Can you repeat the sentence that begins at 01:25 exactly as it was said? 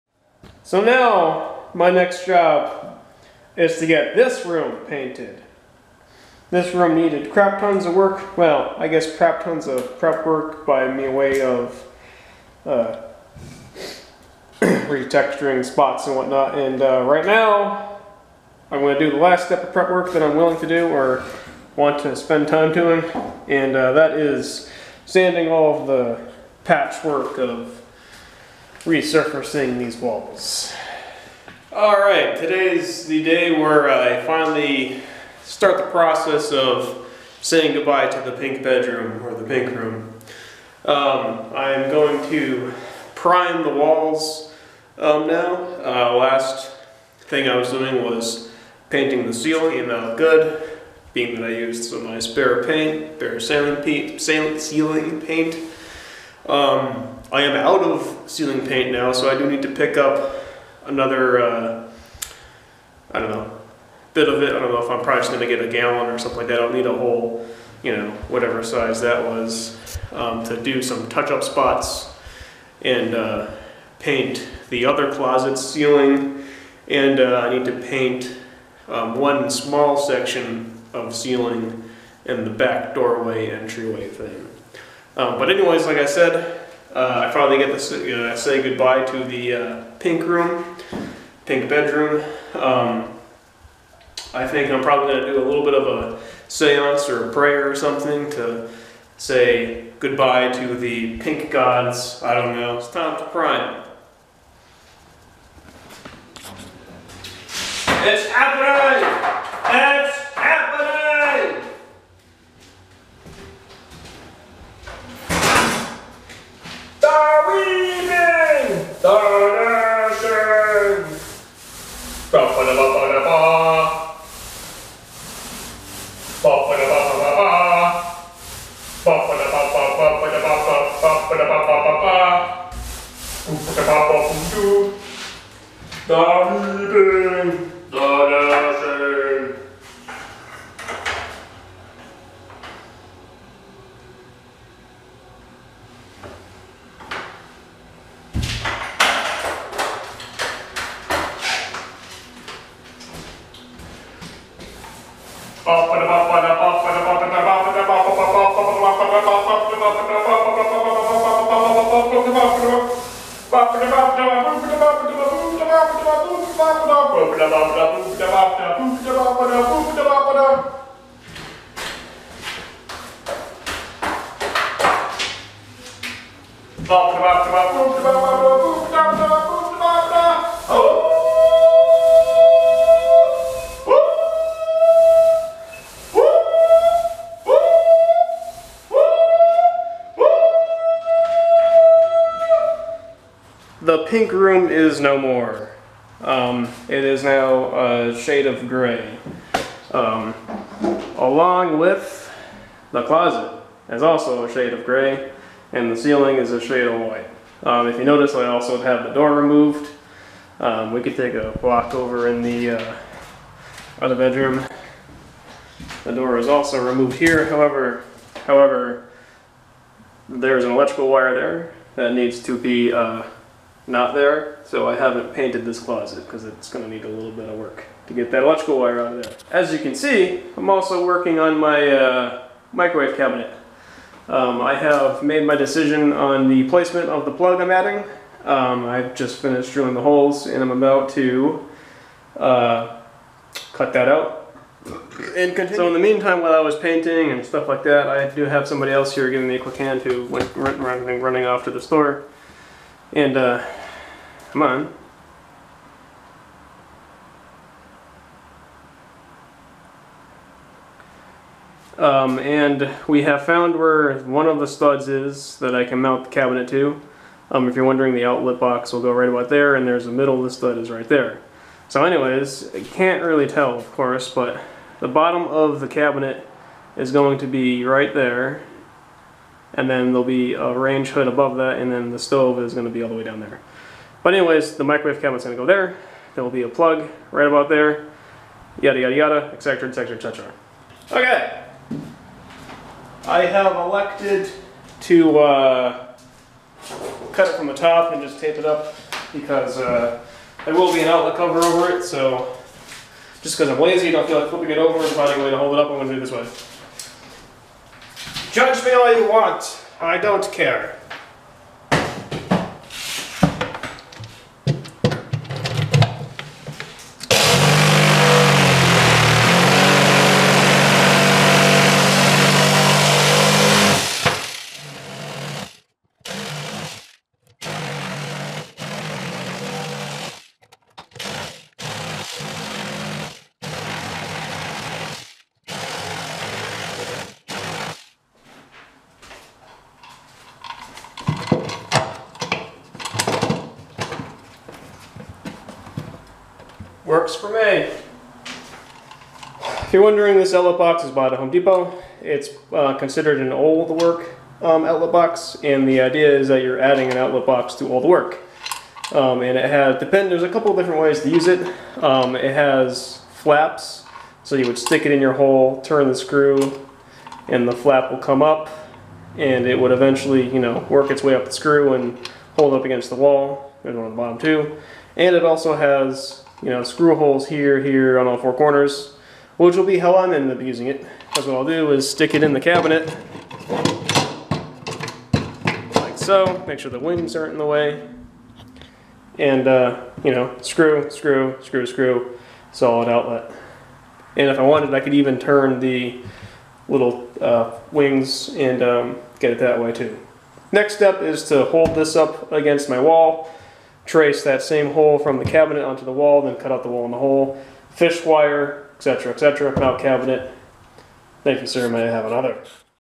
Um, but anyways, like I said, uh, I finally get to uh, say goodbye to the uh, pink room, pink bedroom.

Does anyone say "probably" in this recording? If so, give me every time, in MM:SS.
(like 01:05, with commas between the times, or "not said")
01:05, 01:34.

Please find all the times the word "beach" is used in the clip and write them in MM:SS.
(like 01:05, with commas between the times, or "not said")
not said.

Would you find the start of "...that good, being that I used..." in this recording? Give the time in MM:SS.
00:49.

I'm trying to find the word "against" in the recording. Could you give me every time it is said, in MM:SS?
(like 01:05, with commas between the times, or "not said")
06:12, 06:42.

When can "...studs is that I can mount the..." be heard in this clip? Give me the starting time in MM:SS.
04:24.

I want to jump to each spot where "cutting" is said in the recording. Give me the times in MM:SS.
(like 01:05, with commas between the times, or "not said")
not said.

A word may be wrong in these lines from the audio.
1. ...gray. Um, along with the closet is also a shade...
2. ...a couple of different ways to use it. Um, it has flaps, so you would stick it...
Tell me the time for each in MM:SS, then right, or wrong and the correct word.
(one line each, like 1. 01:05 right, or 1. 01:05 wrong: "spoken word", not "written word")
1. 03:18 right
2. 06:00 right.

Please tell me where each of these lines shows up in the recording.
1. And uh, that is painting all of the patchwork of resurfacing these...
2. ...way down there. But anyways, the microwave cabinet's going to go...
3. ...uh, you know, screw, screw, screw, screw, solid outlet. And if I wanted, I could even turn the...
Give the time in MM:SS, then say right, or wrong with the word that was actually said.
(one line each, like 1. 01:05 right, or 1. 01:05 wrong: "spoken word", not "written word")
1. 00:23 wrong: "sanding", not "painting"
2. 04:43 right
3. 06:29 right.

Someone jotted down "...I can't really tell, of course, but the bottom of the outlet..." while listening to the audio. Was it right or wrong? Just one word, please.
wrong.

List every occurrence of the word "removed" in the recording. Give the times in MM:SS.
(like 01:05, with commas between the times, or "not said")
03:29, 03:36.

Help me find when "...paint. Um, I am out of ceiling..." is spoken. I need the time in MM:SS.
00:55.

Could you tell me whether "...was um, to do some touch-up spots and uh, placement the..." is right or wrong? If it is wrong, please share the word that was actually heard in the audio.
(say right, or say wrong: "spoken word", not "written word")
wrong: "paint", not "placement".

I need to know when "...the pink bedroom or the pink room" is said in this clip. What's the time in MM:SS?
00:38.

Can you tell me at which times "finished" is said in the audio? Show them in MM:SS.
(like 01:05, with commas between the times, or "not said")
03:59.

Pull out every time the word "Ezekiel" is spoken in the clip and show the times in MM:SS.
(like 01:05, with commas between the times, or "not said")
not said.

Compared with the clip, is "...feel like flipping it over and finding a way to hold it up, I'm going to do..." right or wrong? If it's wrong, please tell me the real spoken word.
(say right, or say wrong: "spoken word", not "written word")
right.